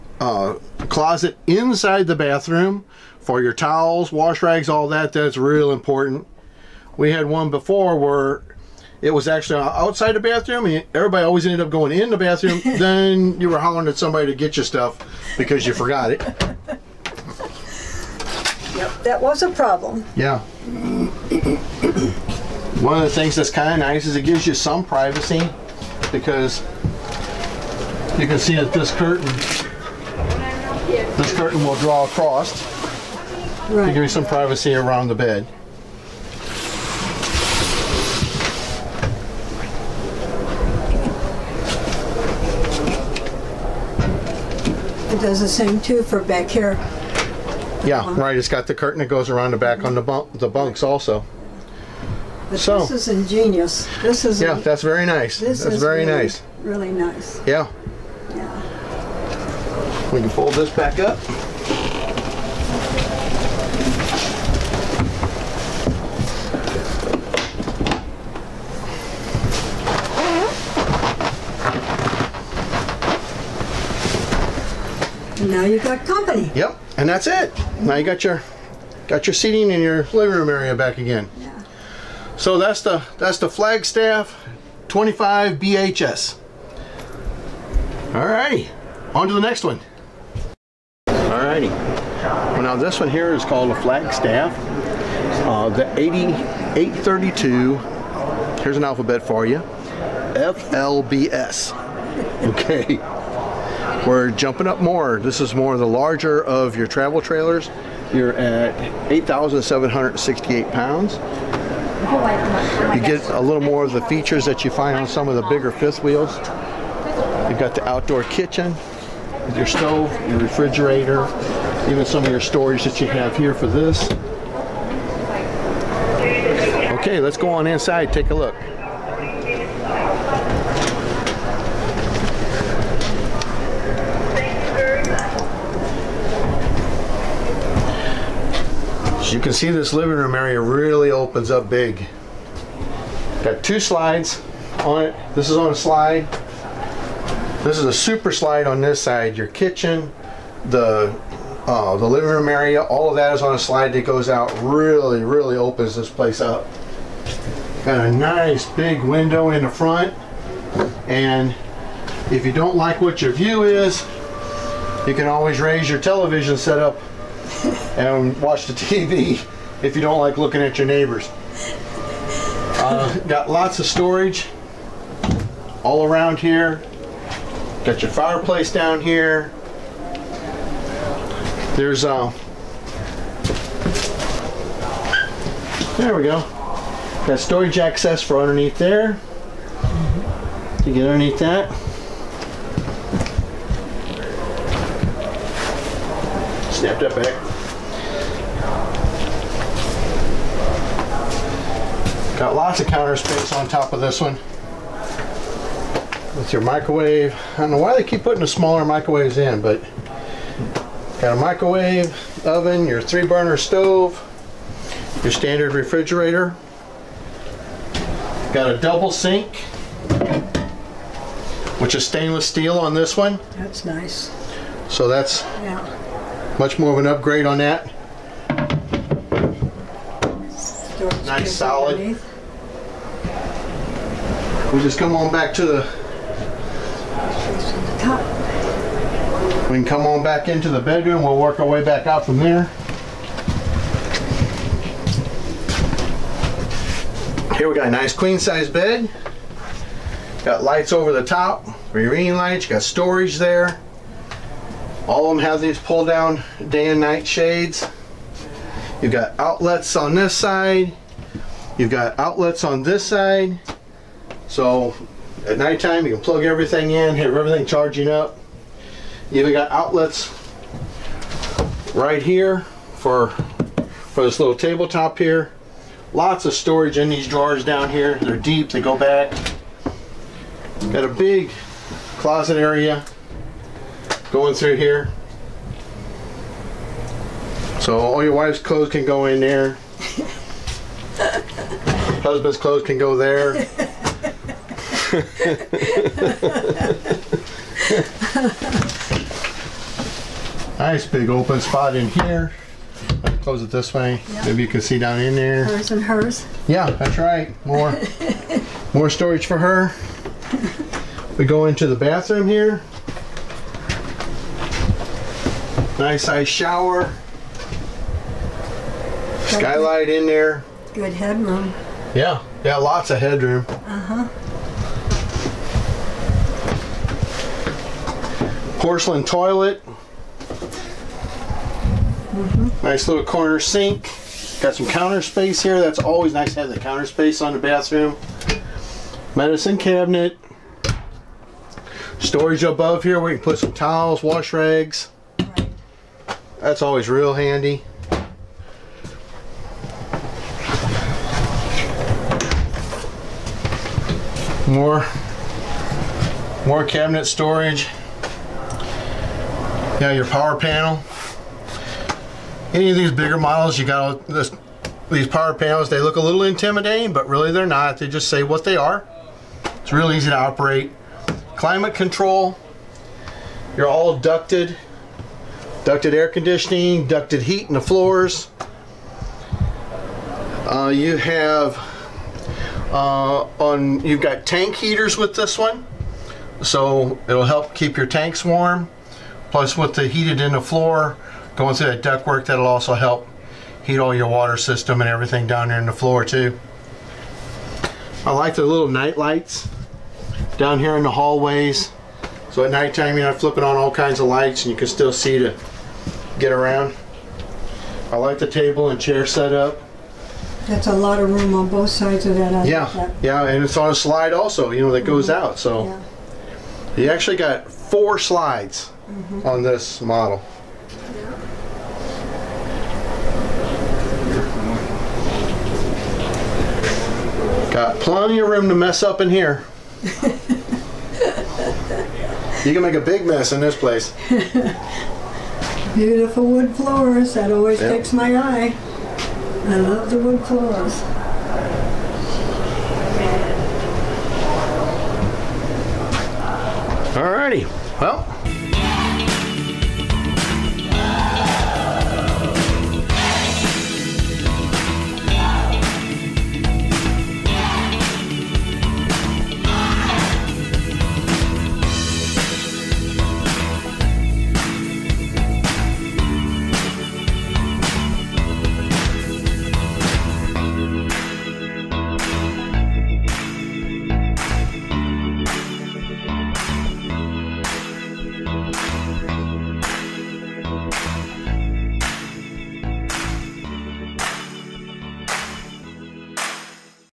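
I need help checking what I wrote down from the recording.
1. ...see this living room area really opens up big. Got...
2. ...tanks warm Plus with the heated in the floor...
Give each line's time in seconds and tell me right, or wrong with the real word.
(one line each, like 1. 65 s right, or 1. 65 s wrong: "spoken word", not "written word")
1. 139 s right
2. 388 s right.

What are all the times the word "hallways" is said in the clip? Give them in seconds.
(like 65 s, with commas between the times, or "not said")
401 s.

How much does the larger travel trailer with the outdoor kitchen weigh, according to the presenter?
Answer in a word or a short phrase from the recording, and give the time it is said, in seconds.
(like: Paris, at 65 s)
8,768 pounds, at 109 s.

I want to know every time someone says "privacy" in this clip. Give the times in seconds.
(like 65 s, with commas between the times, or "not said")
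24 s, 34 s.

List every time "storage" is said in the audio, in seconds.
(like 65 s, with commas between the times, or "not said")
122 s, 173 s, 187 s, 252 s, 276 s, 309 s, 342 s, 357 s.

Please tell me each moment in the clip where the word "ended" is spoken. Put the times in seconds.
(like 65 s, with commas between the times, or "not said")
11 s.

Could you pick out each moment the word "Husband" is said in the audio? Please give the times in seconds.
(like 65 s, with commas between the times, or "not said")
292 s.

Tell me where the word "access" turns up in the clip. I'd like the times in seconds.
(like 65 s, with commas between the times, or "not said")
187 s.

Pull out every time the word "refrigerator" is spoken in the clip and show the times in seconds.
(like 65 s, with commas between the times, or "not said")
120 s, 215 s.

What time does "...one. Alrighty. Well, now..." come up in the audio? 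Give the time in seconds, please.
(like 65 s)
89 s.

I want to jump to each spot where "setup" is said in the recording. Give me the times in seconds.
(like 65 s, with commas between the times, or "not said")
166 s, 409 s.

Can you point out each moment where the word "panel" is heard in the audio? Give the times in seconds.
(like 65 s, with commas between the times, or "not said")
360 s, 365 s.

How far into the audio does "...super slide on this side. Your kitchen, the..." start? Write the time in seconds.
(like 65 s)
147 s.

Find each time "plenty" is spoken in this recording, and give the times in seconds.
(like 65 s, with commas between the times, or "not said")
427 s.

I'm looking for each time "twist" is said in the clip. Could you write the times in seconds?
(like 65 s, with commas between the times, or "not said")
not said.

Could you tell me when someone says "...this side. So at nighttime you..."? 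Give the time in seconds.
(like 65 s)
262 s.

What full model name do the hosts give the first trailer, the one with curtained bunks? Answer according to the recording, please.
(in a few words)
Flagstaff 25 BHS.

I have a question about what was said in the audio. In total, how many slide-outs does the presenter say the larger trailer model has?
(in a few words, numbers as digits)
4.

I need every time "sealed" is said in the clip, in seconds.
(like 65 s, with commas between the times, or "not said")
not said.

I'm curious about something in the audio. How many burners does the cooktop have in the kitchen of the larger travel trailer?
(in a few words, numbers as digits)
3.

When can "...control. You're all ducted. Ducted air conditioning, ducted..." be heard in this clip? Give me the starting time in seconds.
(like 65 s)
371 s.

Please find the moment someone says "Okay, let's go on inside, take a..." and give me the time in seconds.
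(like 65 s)
126 s.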